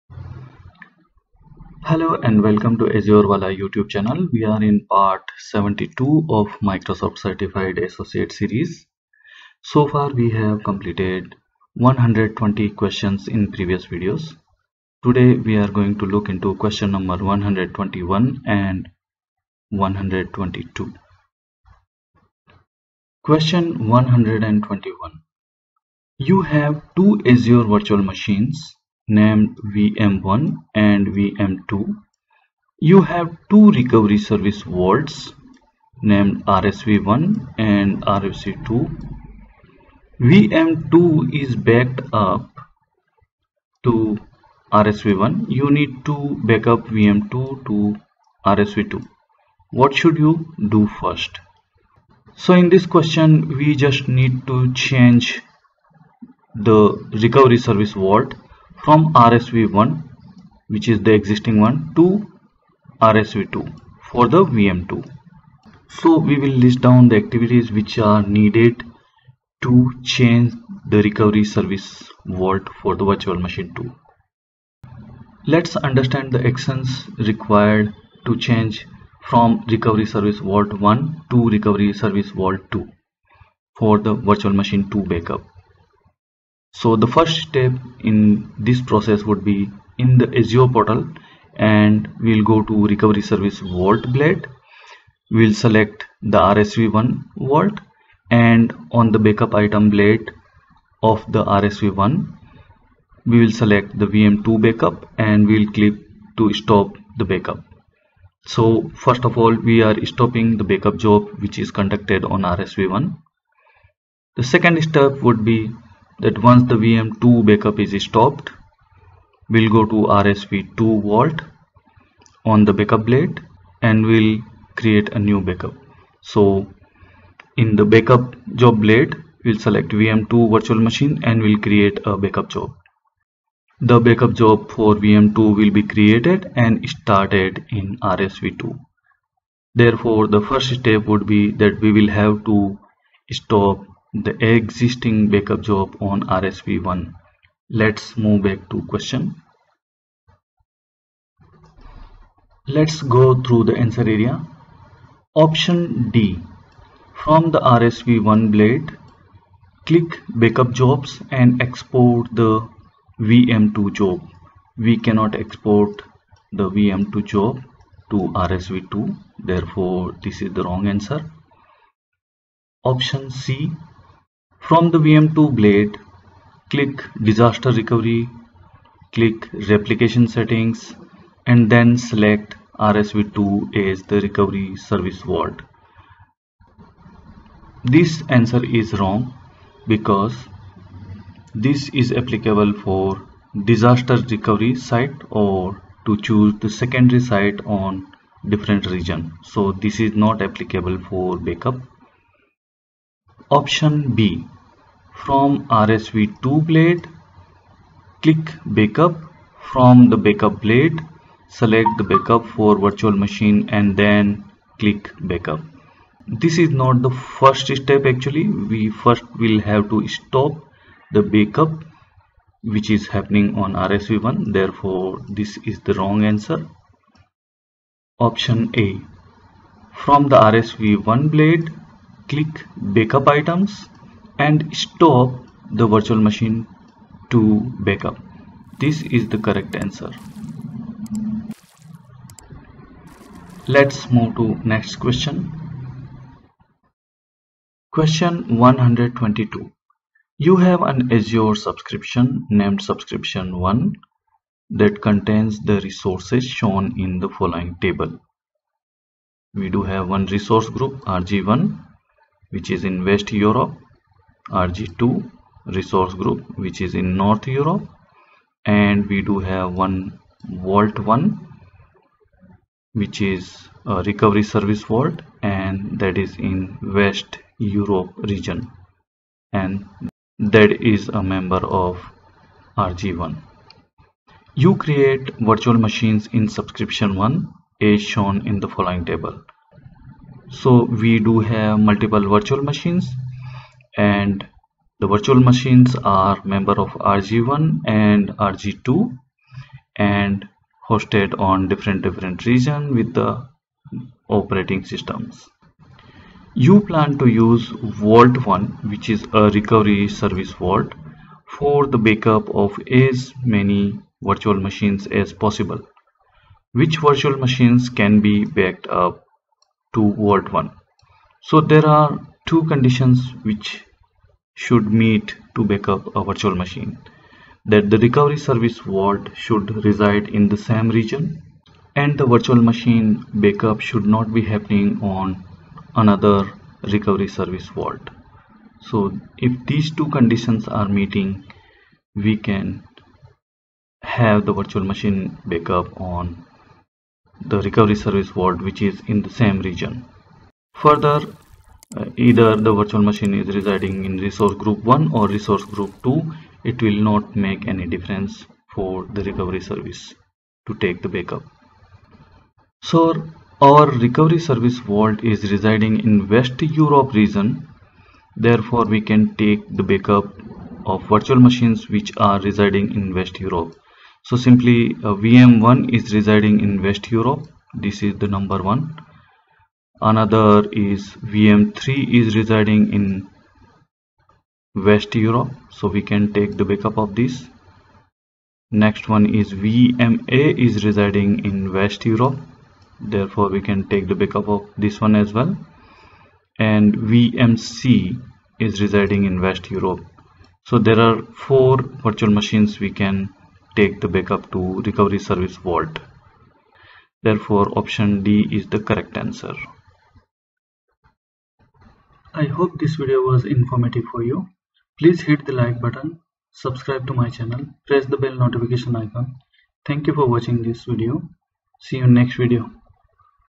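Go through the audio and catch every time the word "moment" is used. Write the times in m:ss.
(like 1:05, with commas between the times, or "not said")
not said.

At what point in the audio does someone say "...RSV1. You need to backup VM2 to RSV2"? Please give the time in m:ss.
0:44.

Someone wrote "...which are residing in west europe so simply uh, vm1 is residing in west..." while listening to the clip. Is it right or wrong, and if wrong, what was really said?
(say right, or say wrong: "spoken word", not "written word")
right.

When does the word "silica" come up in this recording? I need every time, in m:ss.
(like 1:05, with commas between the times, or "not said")
not said.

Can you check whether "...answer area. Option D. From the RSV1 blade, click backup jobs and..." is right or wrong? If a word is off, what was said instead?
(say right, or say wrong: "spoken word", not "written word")
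right.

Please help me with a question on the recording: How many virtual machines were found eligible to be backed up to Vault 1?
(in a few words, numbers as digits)
4.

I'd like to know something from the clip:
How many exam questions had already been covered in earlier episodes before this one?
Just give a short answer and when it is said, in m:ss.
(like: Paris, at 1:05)
120, at 0:11.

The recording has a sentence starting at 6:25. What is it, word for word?
So we can take the backup of this.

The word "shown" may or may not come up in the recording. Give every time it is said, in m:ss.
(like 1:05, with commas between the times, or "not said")
4:16, 4:48.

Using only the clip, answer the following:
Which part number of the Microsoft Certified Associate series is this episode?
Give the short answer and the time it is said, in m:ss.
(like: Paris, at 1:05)
72, at 0:05.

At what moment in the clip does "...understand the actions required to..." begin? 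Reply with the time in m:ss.
1:15.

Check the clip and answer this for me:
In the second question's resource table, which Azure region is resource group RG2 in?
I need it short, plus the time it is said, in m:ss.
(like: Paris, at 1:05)
North Europe, at 4:27.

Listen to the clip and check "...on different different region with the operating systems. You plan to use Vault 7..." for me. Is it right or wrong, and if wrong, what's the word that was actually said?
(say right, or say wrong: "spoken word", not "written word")
wrong: "1", not "7".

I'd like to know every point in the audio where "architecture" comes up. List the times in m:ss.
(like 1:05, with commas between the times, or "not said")
not said.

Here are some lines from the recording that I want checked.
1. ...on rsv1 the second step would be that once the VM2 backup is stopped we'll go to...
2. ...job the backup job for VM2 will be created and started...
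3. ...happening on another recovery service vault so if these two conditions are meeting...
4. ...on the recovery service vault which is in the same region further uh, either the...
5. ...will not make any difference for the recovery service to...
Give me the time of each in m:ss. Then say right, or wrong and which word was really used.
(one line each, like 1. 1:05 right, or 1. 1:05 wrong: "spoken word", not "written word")
1. 1:52 right
2. 2:12 right
3. 5:34 right
4. 5:46 right
5. 5:56 right.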